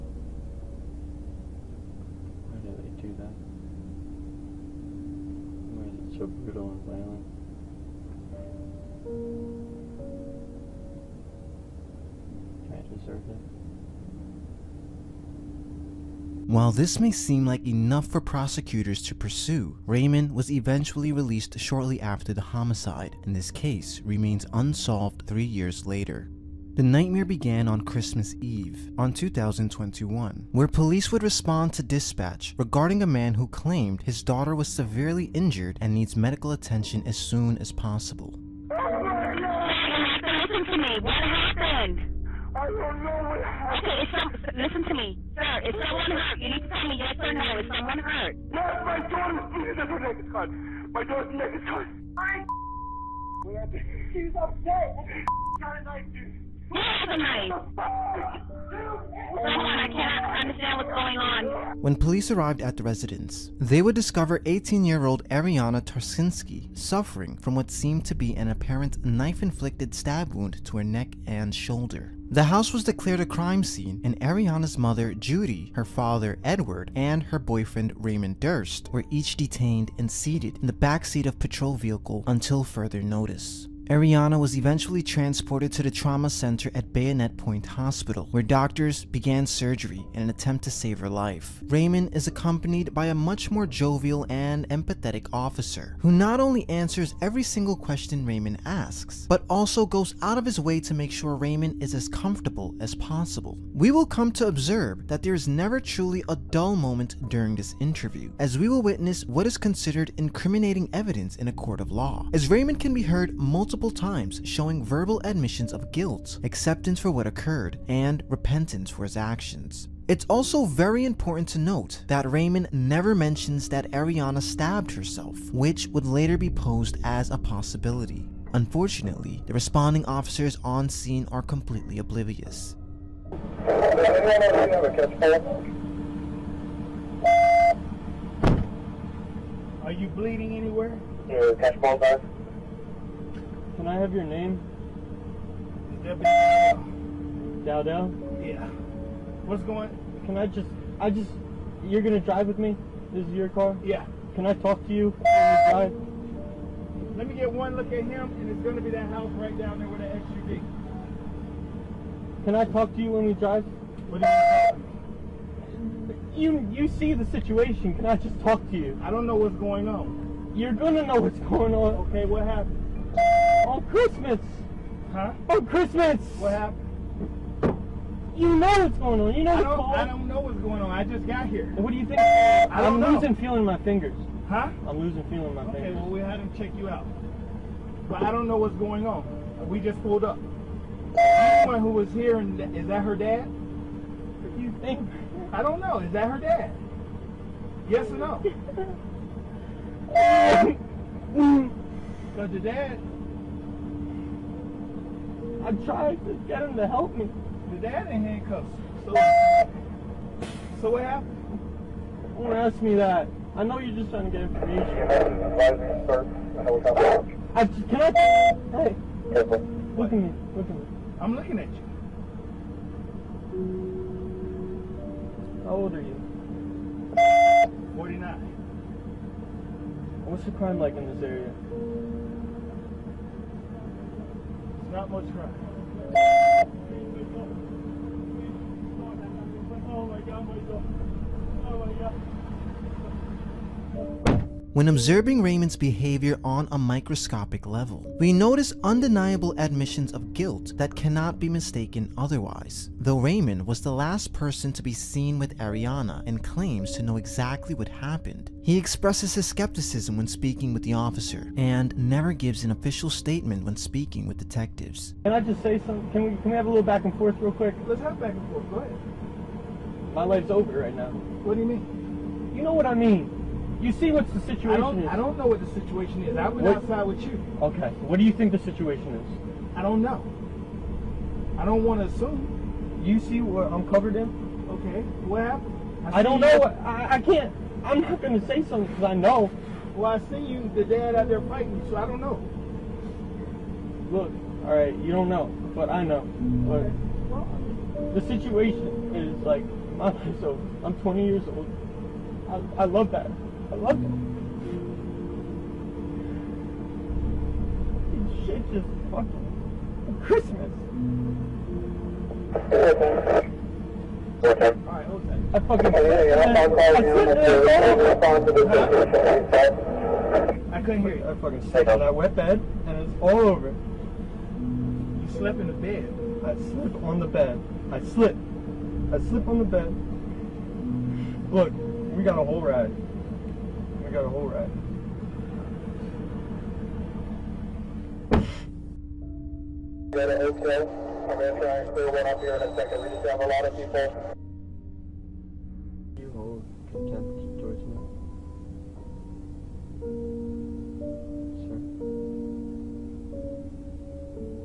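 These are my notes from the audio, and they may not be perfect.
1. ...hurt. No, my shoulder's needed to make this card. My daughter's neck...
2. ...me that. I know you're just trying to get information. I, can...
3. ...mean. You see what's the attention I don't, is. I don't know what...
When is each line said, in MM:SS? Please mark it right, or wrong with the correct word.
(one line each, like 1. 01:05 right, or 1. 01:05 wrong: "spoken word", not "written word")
1. 00:47 wrong: "daughter", not "shoulder"
2. 03:32 right
3. 04:32 wrong: "situation", not "attention".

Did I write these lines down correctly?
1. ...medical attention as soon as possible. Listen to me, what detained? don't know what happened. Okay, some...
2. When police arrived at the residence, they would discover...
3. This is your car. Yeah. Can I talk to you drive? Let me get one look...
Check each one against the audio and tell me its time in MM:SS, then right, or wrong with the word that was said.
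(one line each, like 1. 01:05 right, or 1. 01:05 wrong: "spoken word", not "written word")
1. 00:36 wrong: "happened", not "detained"
2. 01:01 right
3. 02:33 right.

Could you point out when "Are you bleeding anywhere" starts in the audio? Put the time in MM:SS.
02:19.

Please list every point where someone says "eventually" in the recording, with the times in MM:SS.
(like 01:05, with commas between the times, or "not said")
00:20, 01:24.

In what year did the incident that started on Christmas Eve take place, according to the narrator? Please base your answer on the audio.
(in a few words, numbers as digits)
2021.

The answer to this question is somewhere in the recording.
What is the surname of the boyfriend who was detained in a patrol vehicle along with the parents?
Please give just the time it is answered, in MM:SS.
01:18.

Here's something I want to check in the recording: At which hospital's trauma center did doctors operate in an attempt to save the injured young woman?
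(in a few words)
Bayonet Point Hospital.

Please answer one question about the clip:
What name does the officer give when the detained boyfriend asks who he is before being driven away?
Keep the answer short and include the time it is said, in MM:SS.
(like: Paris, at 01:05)
Deputy Dowdell, at 02:26.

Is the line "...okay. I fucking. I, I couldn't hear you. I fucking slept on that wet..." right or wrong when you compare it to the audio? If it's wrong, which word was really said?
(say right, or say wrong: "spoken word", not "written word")
right.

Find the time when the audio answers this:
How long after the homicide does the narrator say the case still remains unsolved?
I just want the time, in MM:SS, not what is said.
00:25.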